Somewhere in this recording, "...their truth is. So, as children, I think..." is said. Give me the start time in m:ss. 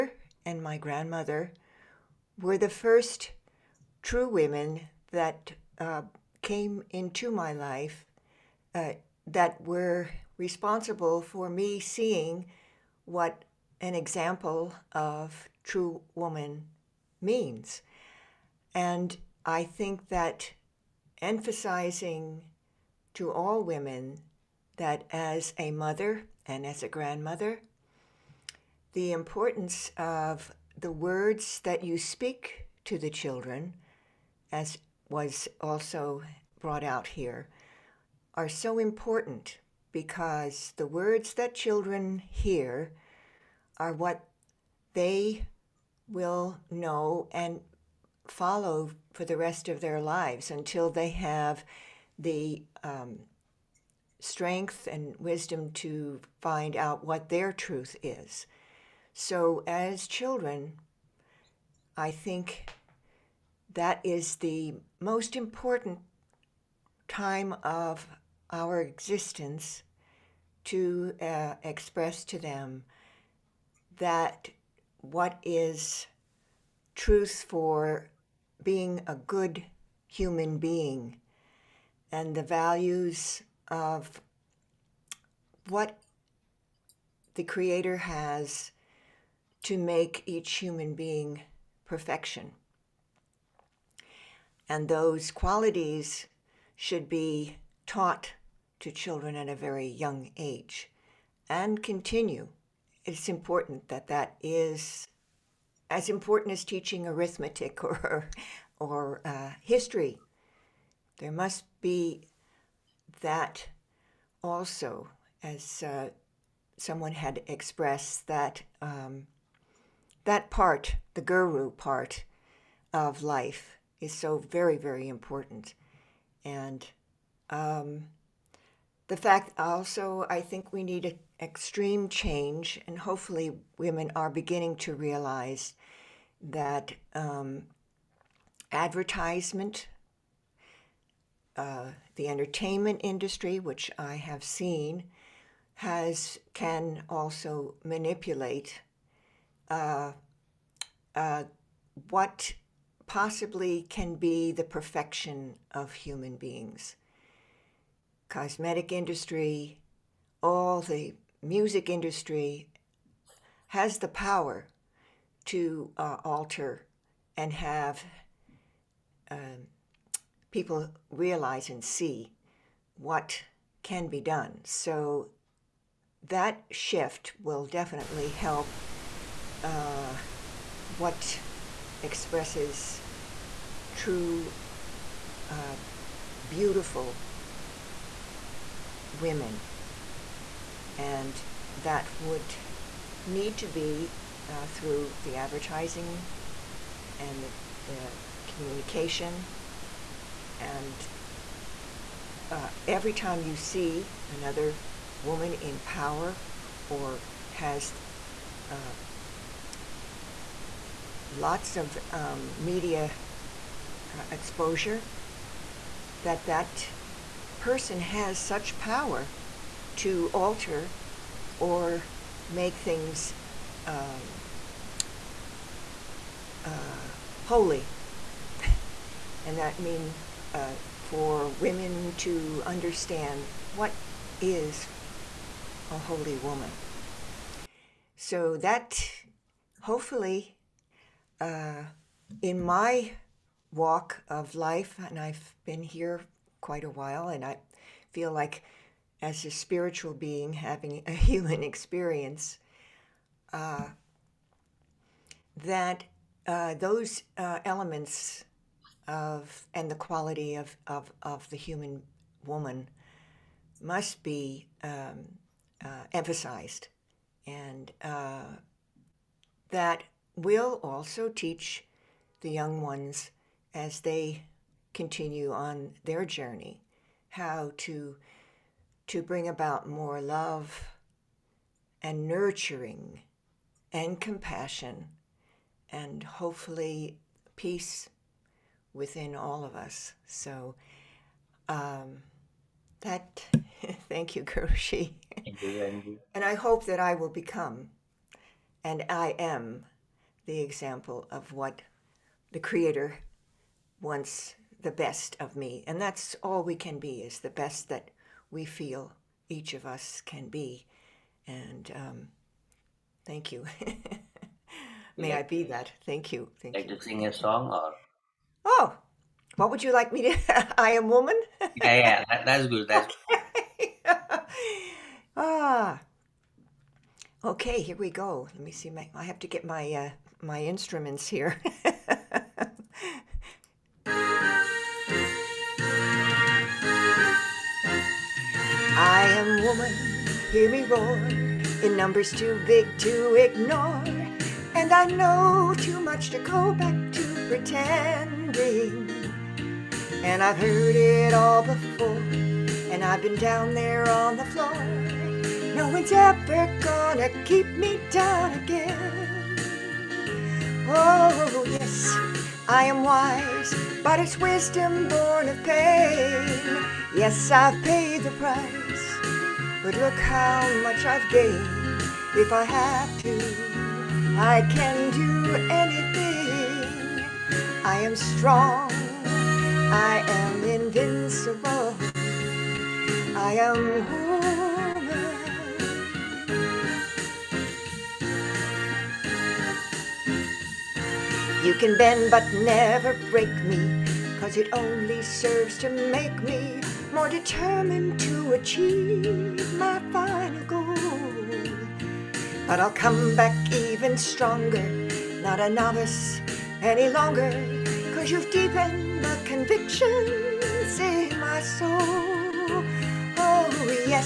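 0:57.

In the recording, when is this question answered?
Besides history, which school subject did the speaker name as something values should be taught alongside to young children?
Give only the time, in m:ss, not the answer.
1:47.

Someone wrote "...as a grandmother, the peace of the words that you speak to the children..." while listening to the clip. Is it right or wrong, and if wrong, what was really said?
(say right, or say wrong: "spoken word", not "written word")
wrong: "importance", not "peace".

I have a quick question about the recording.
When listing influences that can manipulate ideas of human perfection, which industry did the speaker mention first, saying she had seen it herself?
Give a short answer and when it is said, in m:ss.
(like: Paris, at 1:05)
entertainment industry, at 2:22.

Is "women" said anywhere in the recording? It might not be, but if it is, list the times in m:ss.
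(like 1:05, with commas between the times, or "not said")
0:04, 0:23, 2:13, 3:09, 3:51.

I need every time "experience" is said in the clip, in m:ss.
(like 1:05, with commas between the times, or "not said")
4:11.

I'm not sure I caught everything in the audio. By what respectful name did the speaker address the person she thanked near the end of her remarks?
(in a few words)
Guruji.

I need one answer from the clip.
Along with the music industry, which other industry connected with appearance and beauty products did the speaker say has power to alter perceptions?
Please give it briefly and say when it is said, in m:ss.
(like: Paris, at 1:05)
cosmetic industry, at 2:38.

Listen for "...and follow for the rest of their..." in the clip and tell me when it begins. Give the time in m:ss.
0:47.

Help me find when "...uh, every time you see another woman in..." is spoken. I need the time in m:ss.
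3:22.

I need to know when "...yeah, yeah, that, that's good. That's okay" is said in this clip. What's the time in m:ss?
5:21.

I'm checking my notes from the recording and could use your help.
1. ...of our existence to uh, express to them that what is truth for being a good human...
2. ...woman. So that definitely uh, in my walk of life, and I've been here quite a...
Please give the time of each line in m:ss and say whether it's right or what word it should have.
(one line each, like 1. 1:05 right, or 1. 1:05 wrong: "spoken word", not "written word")
1. 1:07 right
2. 3:56 wrong: "hopefully", not "definitely".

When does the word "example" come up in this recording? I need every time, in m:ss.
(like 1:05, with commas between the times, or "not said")
0:13, 5:00.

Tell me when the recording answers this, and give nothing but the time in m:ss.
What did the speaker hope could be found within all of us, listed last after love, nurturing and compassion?
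4:47.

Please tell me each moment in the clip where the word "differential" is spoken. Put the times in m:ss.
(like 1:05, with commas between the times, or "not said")
not said.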